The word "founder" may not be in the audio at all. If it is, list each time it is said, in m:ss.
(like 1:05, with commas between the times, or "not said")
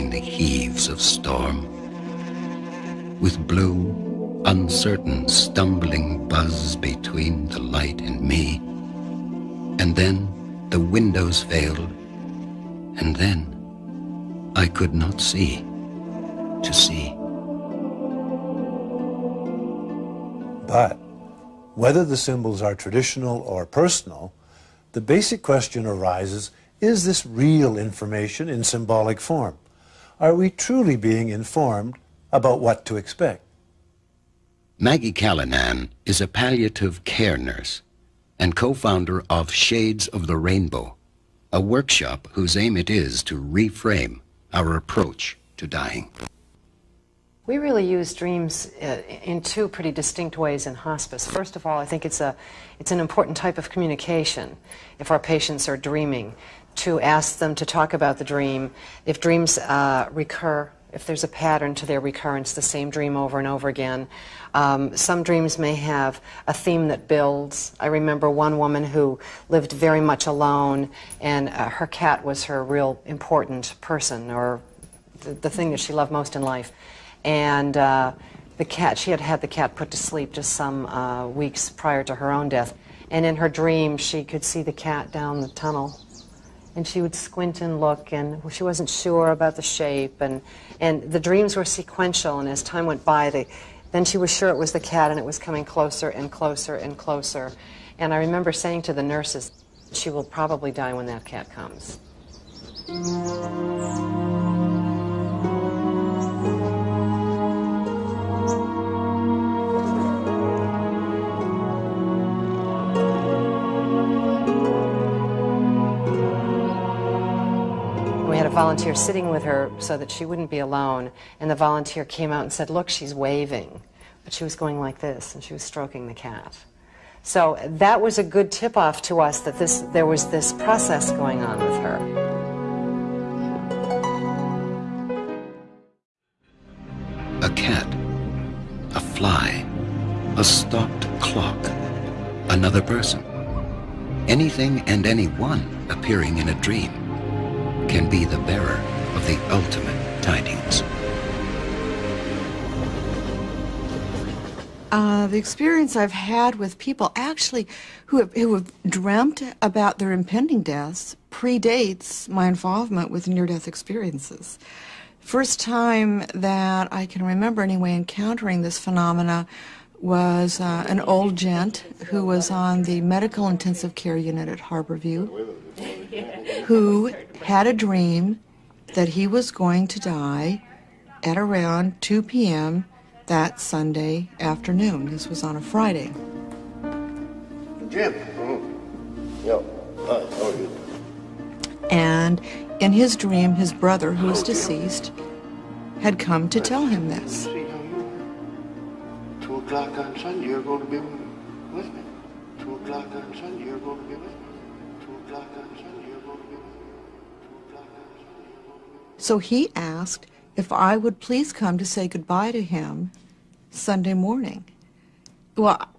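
0:38.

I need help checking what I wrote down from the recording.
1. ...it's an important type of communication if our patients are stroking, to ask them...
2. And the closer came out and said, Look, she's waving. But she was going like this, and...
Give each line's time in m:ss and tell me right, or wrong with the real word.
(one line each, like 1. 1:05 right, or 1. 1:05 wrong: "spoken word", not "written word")
1. 0:52 wrong: "dreaming", not "stroking"
2. 2:01 wrong: "volunteer", not "closer".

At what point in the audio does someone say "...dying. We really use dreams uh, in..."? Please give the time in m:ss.
0:45.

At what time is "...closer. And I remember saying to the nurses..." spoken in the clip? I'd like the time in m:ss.
1:36.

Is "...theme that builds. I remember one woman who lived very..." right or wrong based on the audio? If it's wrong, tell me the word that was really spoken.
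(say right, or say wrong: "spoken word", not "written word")
right.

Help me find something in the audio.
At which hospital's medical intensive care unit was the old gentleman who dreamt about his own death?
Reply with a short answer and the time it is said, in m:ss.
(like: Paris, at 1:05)
Harborview, at 2:54.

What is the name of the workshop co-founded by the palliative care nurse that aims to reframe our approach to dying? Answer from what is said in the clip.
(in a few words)
Shades of the Rainbow.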